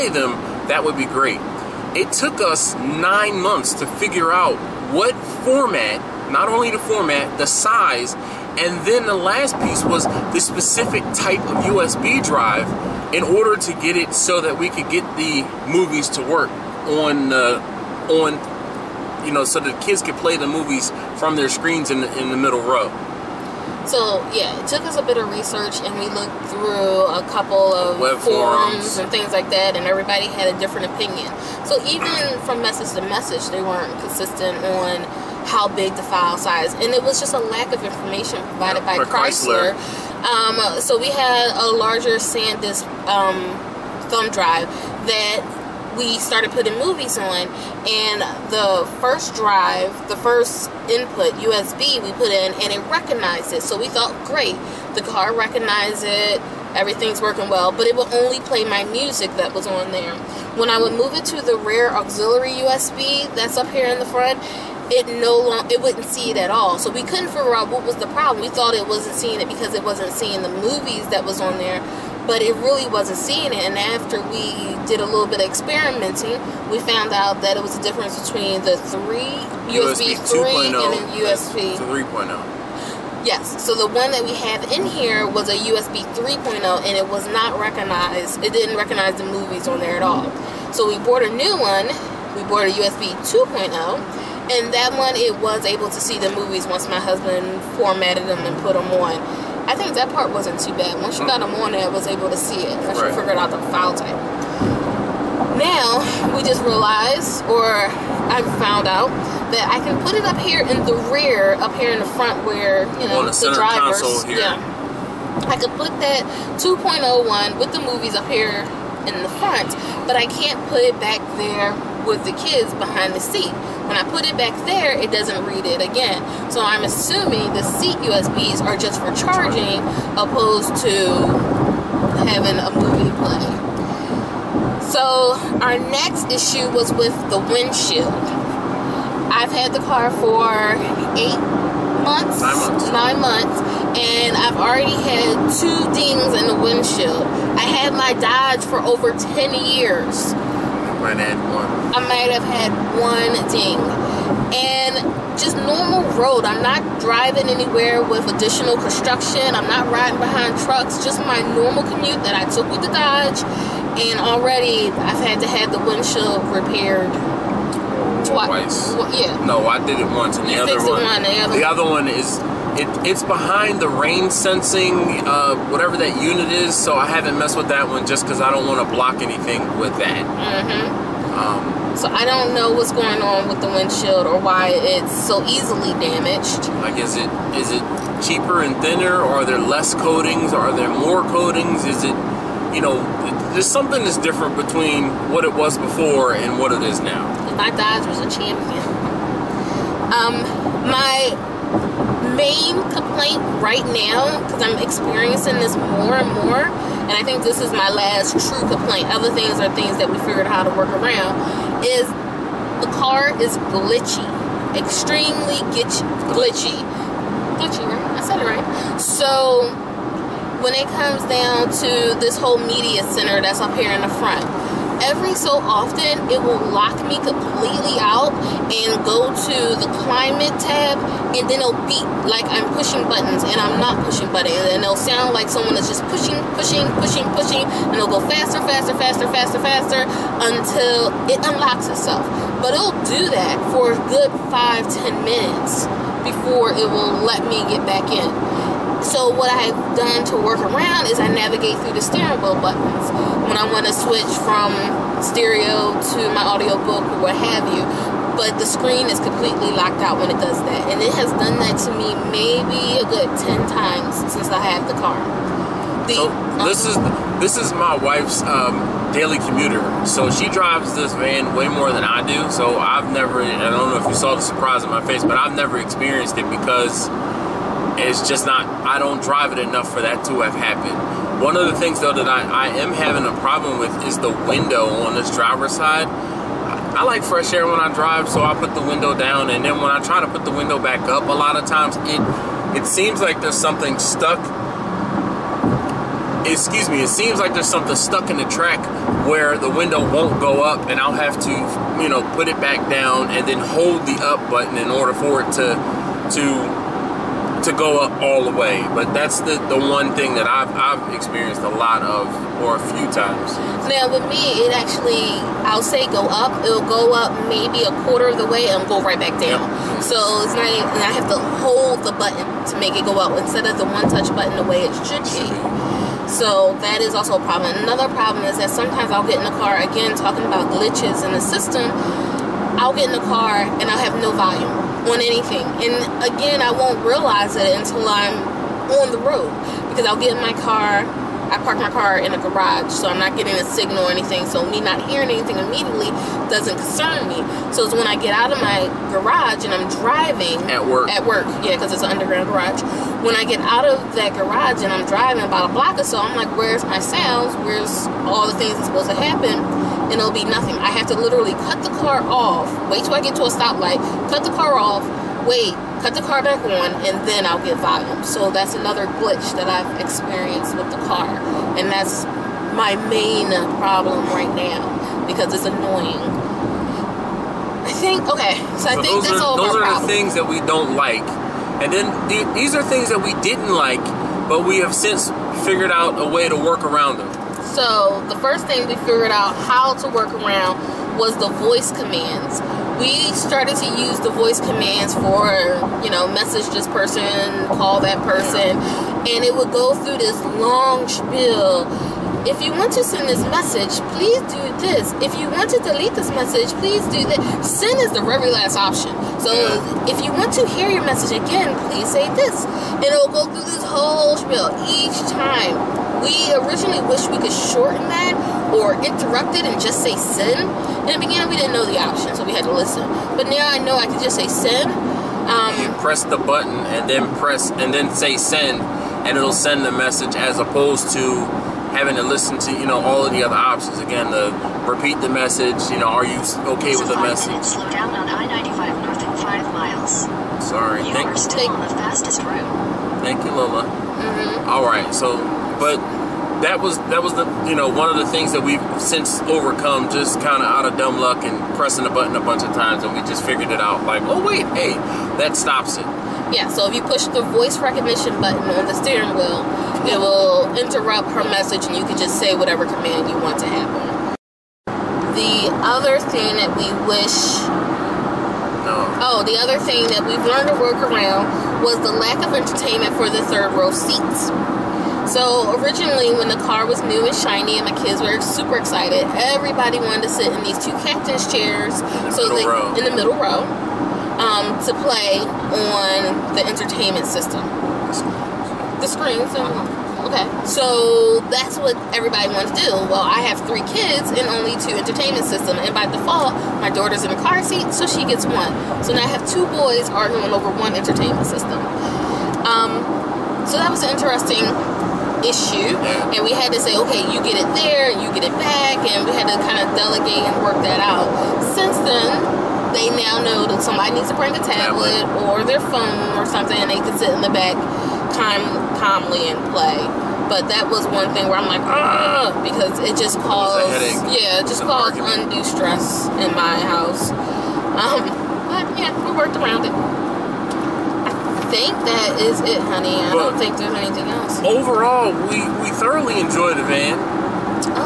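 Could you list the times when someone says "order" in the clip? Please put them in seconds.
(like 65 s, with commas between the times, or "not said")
13 s, 304 s.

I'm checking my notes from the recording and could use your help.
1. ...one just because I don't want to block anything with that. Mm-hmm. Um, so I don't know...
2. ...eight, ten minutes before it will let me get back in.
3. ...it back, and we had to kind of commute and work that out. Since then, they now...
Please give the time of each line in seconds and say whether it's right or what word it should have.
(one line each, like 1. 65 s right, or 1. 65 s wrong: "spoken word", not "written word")
1. 177 s right
2. 244 s wrong: "five", not "eight"
3. 508 s wrong: "delegate", not "commute".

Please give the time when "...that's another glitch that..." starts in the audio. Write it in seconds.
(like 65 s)
368 s.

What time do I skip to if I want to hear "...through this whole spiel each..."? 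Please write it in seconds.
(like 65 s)
413 s.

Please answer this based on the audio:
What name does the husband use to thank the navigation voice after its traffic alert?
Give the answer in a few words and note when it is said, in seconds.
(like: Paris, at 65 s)
Lola, at 443 s.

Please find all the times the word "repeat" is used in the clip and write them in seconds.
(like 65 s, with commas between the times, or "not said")
434 s.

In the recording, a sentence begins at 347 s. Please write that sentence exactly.
So it's when I get out of my garage and I'm driving at work.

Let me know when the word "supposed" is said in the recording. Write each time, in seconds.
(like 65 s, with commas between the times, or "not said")
358 s.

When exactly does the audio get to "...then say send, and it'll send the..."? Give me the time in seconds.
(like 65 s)
427 s.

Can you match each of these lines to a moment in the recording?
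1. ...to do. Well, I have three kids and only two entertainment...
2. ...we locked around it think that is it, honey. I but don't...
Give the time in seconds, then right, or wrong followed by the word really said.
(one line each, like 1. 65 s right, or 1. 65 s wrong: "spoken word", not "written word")
1. 492 s right
2. 529 s wrong: "worked", not "locked".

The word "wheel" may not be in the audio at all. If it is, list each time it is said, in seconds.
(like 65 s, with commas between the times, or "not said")
252 s, 459 s.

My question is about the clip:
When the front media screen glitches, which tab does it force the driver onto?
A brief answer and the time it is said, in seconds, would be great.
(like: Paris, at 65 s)
climate, at 230 s.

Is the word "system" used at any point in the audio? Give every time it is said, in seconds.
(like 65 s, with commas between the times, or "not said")
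331 s, 487 s, 495 s, 501 s.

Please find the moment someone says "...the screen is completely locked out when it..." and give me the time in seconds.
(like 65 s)
258 s.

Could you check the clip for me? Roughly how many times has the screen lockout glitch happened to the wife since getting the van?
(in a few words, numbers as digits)
10.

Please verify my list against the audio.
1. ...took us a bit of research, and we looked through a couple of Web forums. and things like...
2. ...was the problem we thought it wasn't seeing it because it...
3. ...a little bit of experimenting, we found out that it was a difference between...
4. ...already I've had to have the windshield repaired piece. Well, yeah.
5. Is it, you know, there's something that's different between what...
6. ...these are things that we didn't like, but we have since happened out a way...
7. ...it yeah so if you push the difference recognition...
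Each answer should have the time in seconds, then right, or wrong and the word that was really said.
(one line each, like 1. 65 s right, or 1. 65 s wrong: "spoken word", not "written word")
1. 24 s right
2. 67 s right
3. 74 s right
4. 164 s wrong: "twice", not "piece"
5. 191 s right
6. 382 s wrong: "figured", not "happened"
7. 455 s wrong: "voice", not "difference".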